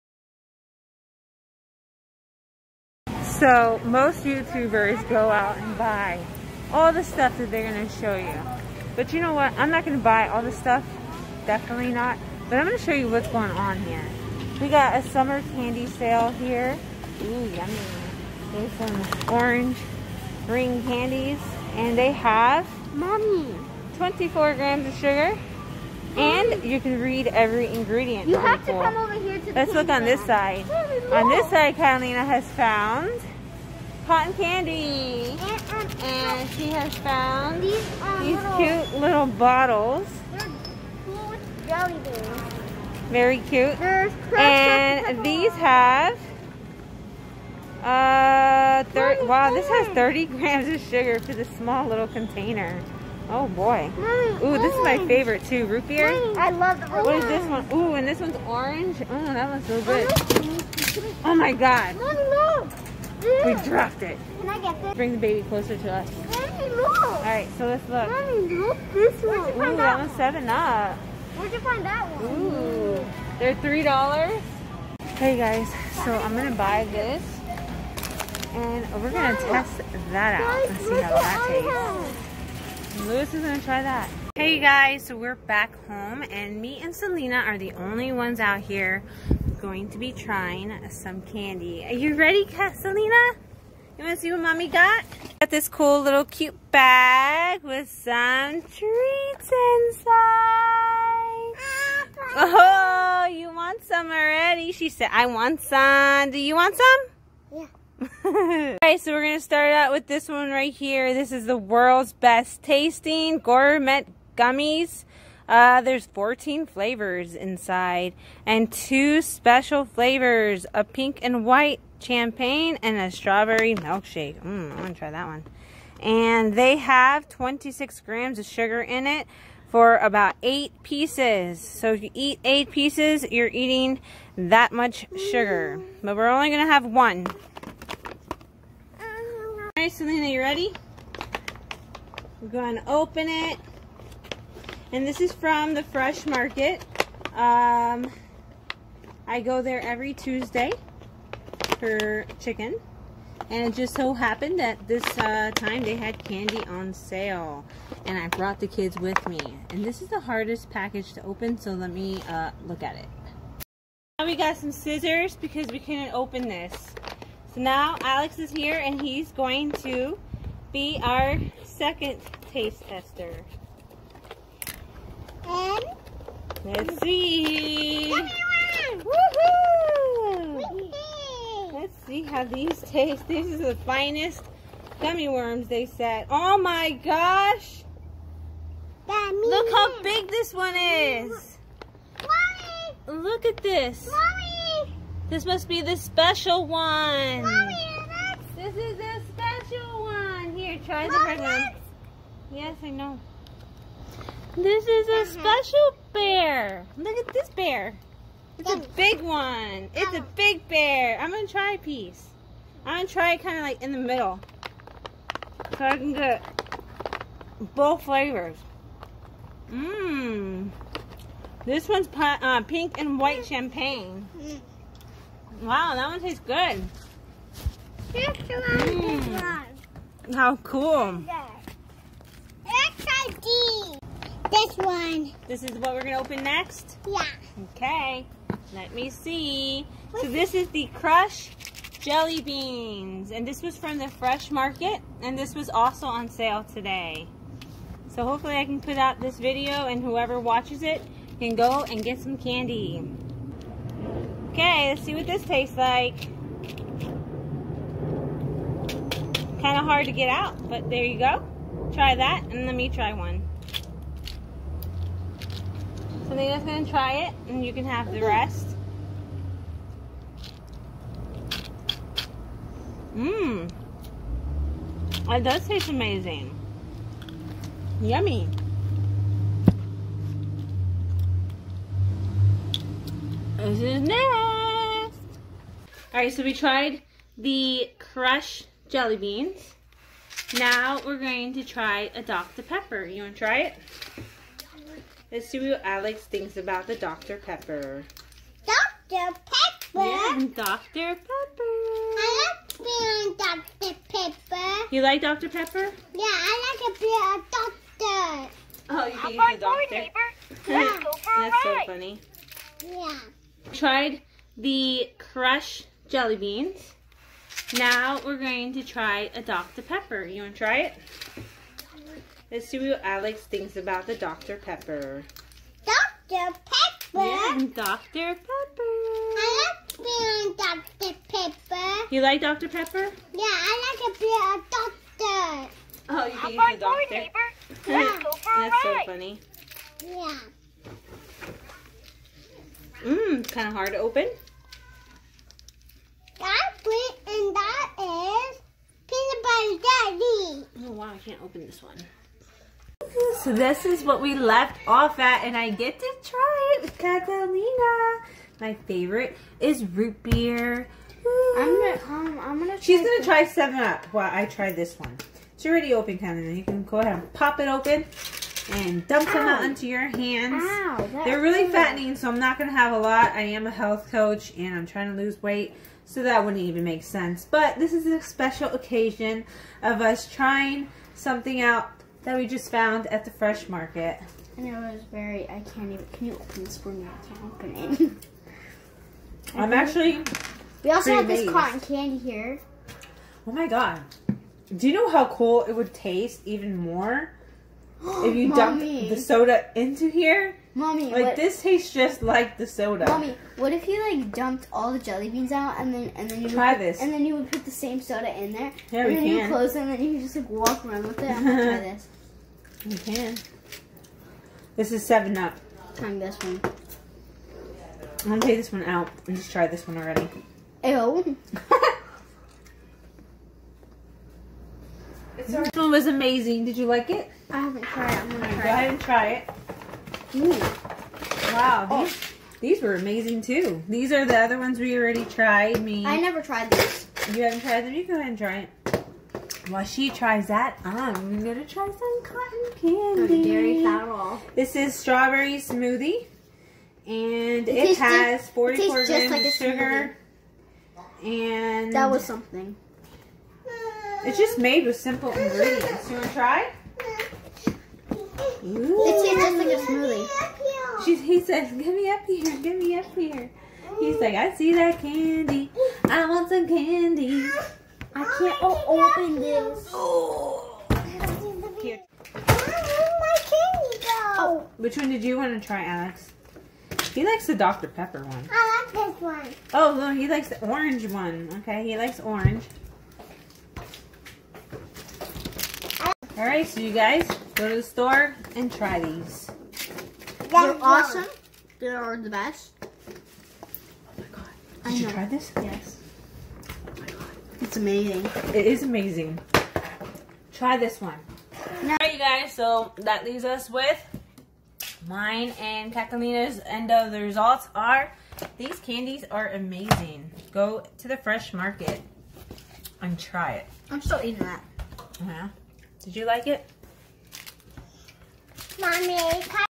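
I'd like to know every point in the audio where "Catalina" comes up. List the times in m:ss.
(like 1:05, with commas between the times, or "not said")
0:31, 5:56, 6:06, 8:25.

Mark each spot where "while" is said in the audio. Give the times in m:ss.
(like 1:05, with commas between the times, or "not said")
6:04, 7:19.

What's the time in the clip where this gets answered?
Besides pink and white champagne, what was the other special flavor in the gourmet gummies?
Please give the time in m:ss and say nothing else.
2:03.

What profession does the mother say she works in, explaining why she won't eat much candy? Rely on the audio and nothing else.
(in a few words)
health coach.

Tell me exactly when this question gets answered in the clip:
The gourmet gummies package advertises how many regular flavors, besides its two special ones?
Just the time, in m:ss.
1:56.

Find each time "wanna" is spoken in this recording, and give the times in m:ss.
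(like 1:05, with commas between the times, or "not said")
1:34, 7:36.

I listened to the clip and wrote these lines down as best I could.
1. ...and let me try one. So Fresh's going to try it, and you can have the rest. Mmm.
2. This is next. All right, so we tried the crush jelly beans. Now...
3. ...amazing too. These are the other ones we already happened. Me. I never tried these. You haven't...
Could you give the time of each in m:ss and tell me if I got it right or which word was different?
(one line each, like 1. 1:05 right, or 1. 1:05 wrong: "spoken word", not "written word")
1. 4:22 wrong: "Nina", not "Fresh"
2. 4:43 right
3. 7:12 wrong: "tried", not "happened".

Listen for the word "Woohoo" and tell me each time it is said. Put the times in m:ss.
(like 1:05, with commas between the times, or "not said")
2:58.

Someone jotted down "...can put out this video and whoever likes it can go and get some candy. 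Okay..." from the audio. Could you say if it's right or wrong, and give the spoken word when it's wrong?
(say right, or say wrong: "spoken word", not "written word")
wrong: "watches", not "likes".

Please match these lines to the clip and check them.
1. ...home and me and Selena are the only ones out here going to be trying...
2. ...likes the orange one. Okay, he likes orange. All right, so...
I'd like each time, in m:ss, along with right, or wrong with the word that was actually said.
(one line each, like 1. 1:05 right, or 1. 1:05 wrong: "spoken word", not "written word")
1. 1:25 right
2. 8:00 right.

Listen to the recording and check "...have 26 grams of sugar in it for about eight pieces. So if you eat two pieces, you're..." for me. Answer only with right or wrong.
wrong.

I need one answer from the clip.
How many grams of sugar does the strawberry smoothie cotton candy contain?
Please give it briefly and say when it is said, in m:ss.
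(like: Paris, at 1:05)
44 grams, at 7:28.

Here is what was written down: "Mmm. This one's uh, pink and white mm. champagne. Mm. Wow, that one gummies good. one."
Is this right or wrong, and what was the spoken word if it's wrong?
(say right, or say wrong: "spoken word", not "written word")
wrong: "tastes", not "gummies".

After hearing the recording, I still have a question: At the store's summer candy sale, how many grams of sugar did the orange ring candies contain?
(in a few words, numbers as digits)
24 grams.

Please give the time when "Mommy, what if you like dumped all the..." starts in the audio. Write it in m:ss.
6:43.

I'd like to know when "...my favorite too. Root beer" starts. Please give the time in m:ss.
0:54.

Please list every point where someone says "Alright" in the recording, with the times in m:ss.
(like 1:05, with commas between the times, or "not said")
1:48, 8:21.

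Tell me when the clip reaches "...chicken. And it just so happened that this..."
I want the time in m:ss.
2:32.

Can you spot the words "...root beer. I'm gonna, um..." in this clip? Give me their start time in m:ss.
5:59.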